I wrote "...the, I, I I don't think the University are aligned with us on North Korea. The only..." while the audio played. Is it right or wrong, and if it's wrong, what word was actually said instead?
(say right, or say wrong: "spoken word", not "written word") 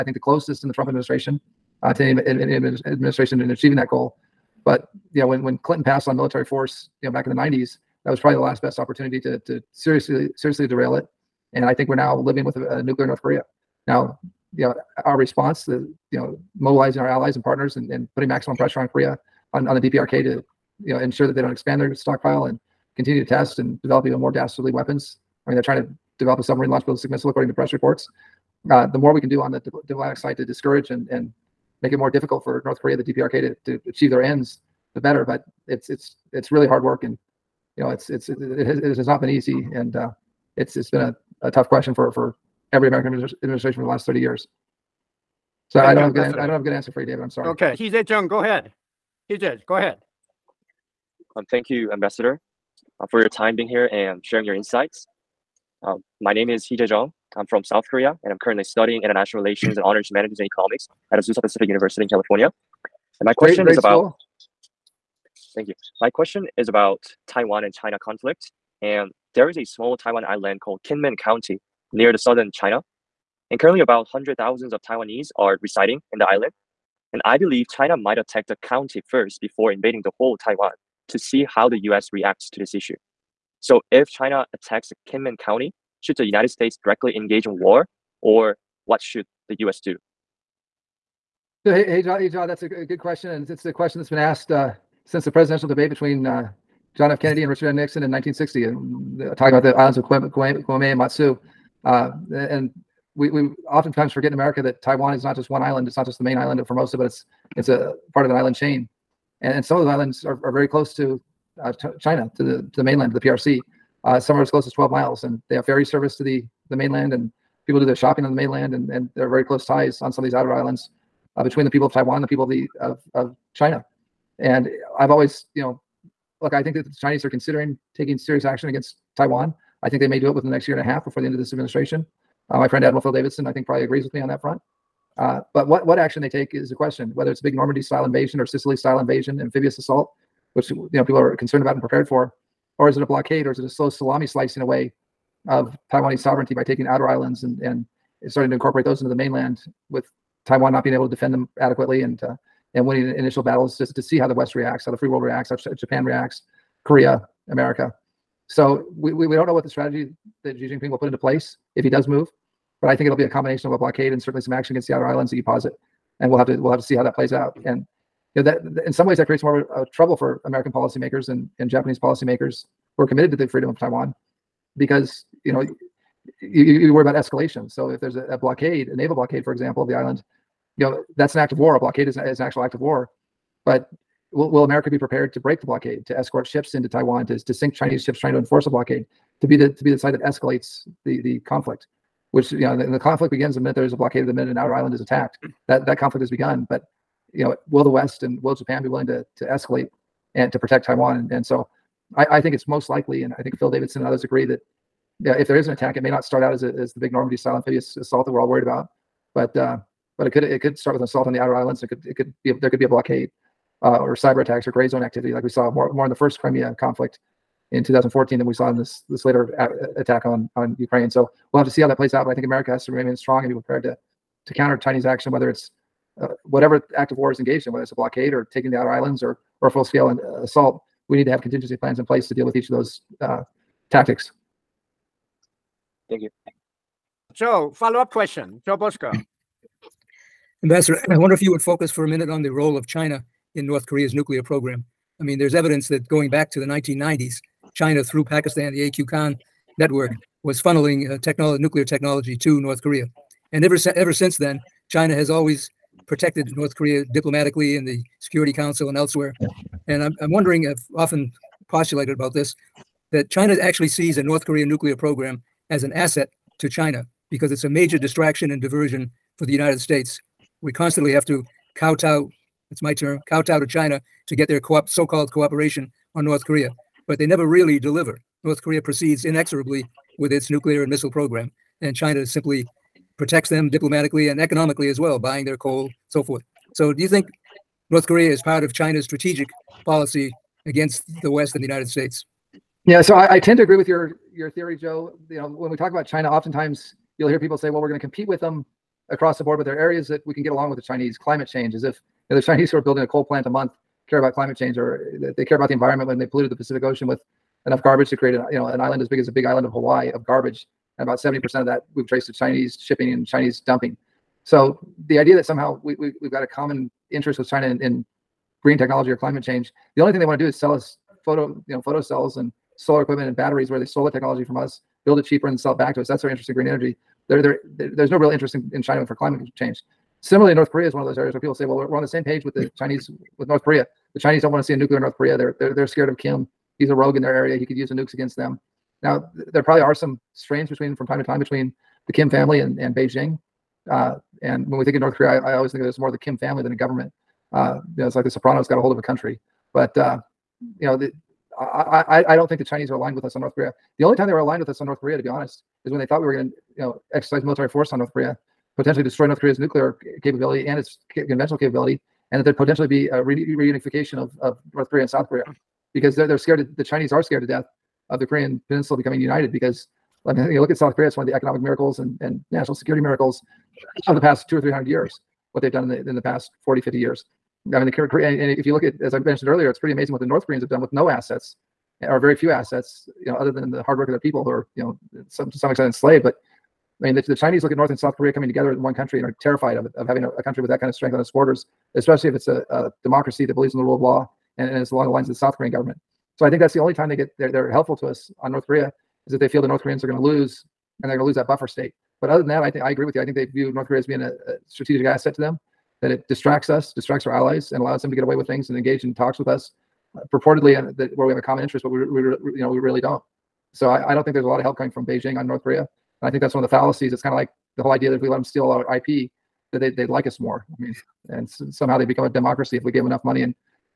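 wrong: "Chinese", not "University".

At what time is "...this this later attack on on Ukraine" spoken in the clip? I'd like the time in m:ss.
3:38.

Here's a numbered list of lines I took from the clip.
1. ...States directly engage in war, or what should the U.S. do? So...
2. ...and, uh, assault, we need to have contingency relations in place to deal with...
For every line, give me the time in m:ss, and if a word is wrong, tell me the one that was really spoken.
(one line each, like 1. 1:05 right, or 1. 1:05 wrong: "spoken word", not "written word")
1. 1:26 right
2. 3:50 wrong: "plans", not "relations".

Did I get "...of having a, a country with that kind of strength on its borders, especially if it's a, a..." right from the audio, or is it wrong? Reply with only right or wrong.
right.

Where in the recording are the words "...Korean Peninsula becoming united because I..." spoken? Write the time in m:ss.
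6:08.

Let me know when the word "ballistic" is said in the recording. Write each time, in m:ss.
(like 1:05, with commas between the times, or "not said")
0:26.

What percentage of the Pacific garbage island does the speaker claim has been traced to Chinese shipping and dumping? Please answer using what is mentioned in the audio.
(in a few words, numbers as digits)
70%.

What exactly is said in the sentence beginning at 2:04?
And I've always, you know, look, I think that the Chinese are considering taking serious action against Taiwan.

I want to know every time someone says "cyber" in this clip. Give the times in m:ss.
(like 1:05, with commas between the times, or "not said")
3:34.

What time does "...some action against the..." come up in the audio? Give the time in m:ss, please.
2:44.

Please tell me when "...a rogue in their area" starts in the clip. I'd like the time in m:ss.
5:36.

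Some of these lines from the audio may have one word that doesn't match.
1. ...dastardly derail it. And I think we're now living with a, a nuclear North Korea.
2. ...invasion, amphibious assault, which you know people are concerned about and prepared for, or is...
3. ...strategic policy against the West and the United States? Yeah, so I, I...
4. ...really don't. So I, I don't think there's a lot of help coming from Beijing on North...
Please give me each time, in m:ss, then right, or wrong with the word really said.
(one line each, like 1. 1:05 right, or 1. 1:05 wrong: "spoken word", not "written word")
1. 0:10 wrong: "seriously", not "dastardly"
2. 2:18 right
3. 4:49 right
4. 6:52 right.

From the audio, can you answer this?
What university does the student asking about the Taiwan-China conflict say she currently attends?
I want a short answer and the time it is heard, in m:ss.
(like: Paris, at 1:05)
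Azusa Pacific University, at 1:01.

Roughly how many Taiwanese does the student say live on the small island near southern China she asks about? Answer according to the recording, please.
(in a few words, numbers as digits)
100,000.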